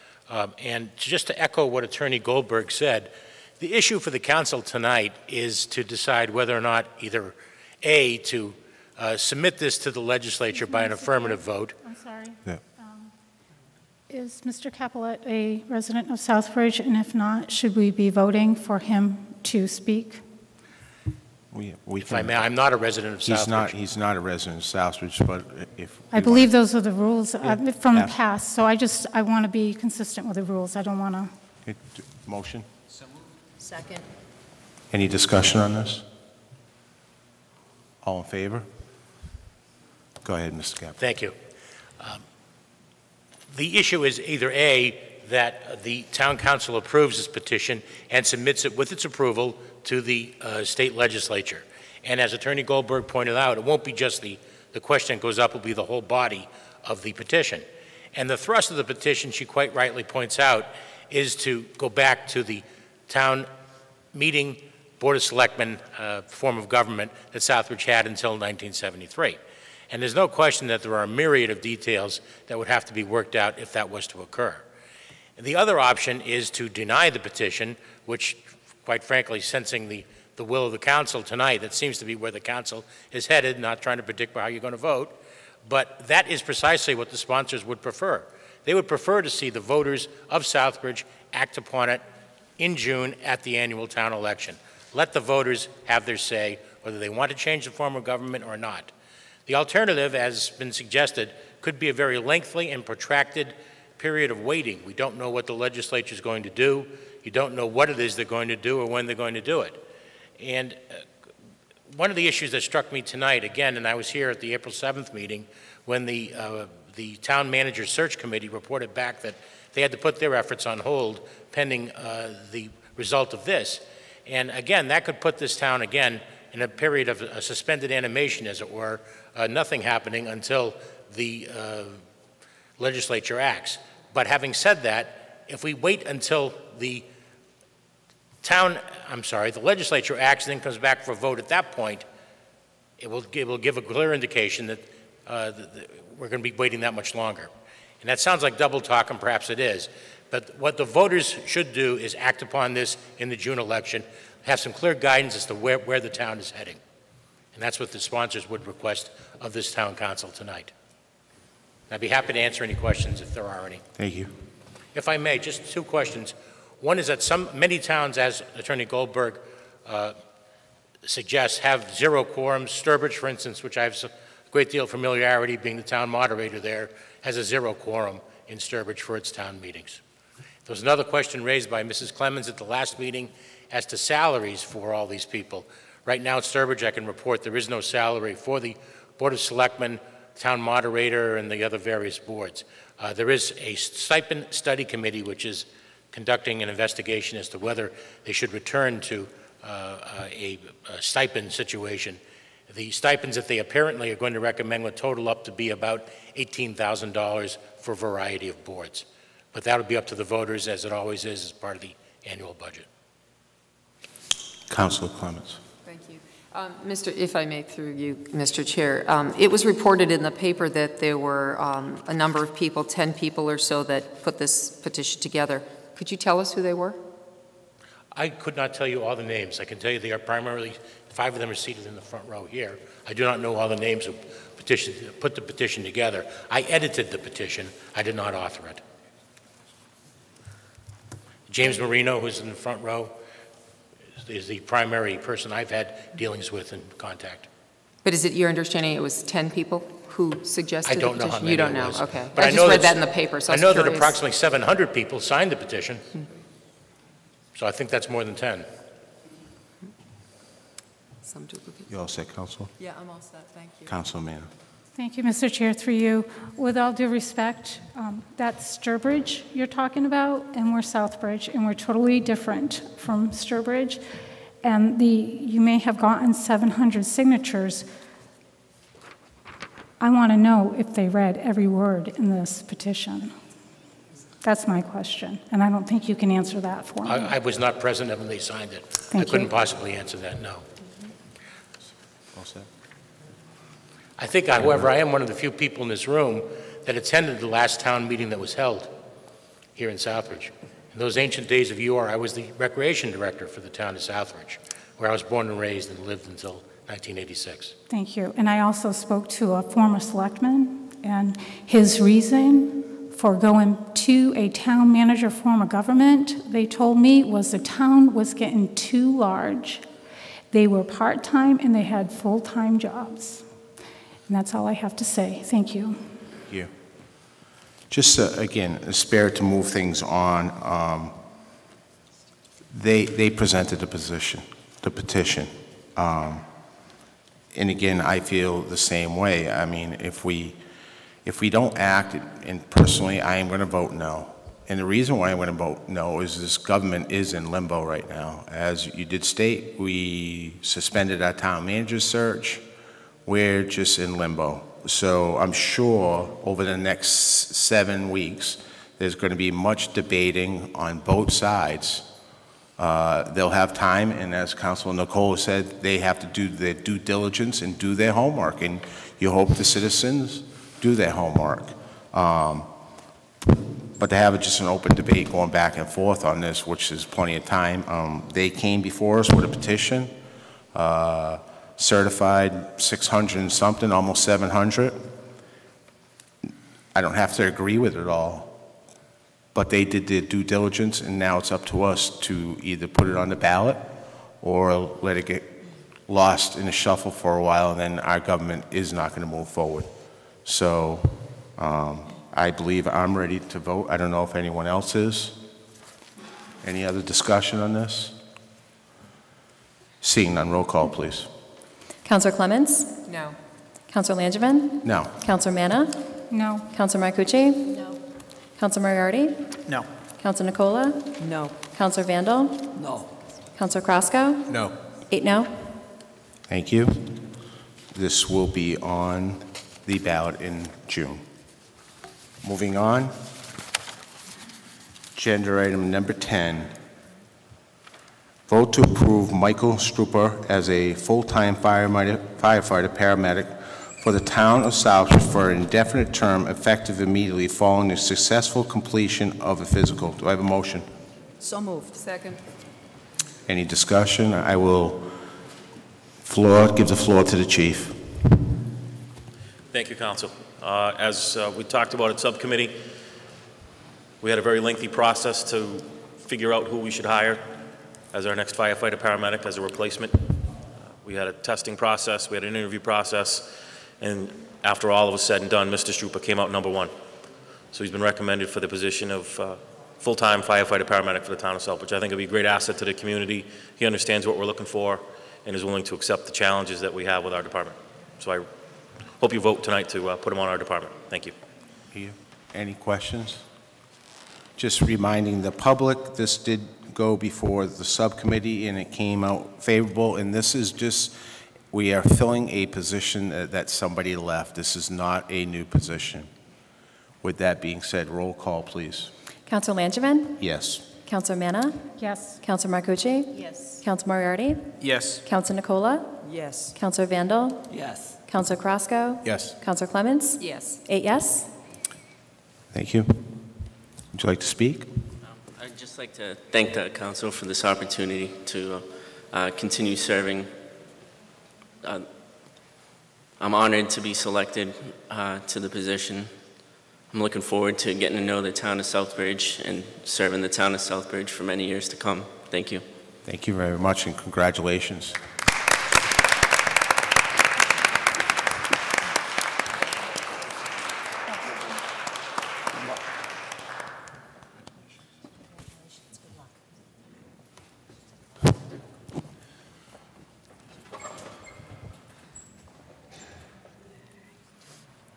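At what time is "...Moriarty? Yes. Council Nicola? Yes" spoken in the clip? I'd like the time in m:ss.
8:34.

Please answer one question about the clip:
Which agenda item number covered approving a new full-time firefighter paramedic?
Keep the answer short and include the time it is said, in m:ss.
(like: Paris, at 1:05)
10, at 7:15.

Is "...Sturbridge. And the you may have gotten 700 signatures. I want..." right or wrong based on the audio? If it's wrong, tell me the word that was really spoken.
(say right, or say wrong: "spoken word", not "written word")
right.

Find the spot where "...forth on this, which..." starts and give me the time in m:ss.
6:15.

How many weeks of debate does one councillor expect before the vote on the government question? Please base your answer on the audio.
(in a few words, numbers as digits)
7.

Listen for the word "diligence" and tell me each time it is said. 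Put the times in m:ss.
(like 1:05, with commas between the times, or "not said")
6:06, 6:30.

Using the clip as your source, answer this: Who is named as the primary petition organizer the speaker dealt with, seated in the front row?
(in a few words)
James Marino.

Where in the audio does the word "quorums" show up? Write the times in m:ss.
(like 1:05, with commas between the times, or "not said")
2:52, 2:57.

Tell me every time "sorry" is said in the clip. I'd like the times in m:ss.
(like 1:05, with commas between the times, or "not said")
0:11, 2:19.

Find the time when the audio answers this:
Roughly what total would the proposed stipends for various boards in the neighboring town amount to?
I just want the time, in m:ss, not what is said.
3:26.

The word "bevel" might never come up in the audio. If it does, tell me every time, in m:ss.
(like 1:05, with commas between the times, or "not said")
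not said.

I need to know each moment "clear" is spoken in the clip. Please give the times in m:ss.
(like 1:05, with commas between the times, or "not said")
2:23, 2:34.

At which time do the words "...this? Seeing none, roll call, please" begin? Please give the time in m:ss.
6:47.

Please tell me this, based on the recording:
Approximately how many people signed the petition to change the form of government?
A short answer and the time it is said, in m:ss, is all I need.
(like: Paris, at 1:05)
700, at 4:13.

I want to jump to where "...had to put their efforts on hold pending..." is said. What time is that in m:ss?
1:59.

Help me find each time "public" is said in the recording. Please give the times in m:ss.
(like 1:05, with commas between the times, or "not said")
8:15.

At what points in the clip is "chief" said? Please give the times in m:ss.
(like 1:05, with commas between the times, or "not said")
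7:37.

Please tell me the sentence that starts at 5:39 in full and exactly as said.
I mean, if we, if we don't act, and personally, I am going to vote no.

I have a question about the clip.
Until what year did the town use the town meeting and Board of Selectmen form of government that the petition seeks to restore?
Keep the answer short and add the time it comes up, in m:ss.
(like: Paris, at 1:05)
1973, at 1:08.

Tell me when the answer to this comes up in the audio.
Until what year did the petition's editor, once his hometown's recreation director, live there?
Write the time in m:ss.
5:06.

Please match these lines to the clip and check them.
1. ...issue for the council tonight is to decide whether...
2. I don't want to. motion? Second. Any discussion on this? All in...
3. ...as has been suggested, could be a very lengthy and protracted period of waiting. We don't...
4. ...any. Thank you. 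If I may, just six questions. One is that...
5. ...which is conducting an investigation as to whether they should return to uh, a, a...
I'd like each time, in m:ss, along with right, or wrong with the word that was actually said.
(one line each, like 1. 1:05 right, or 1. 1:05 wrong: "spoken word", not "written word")
1. 0:03 right
2. 0:30 right
3. 1:40 right
4. 2:43 wrong: "two", not "six"
5. 3:15 right.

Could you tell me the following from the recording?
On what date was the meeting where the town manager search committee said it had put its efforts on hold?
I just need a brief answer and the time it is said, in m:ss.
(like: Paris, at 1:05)
April 7th, at 1:54.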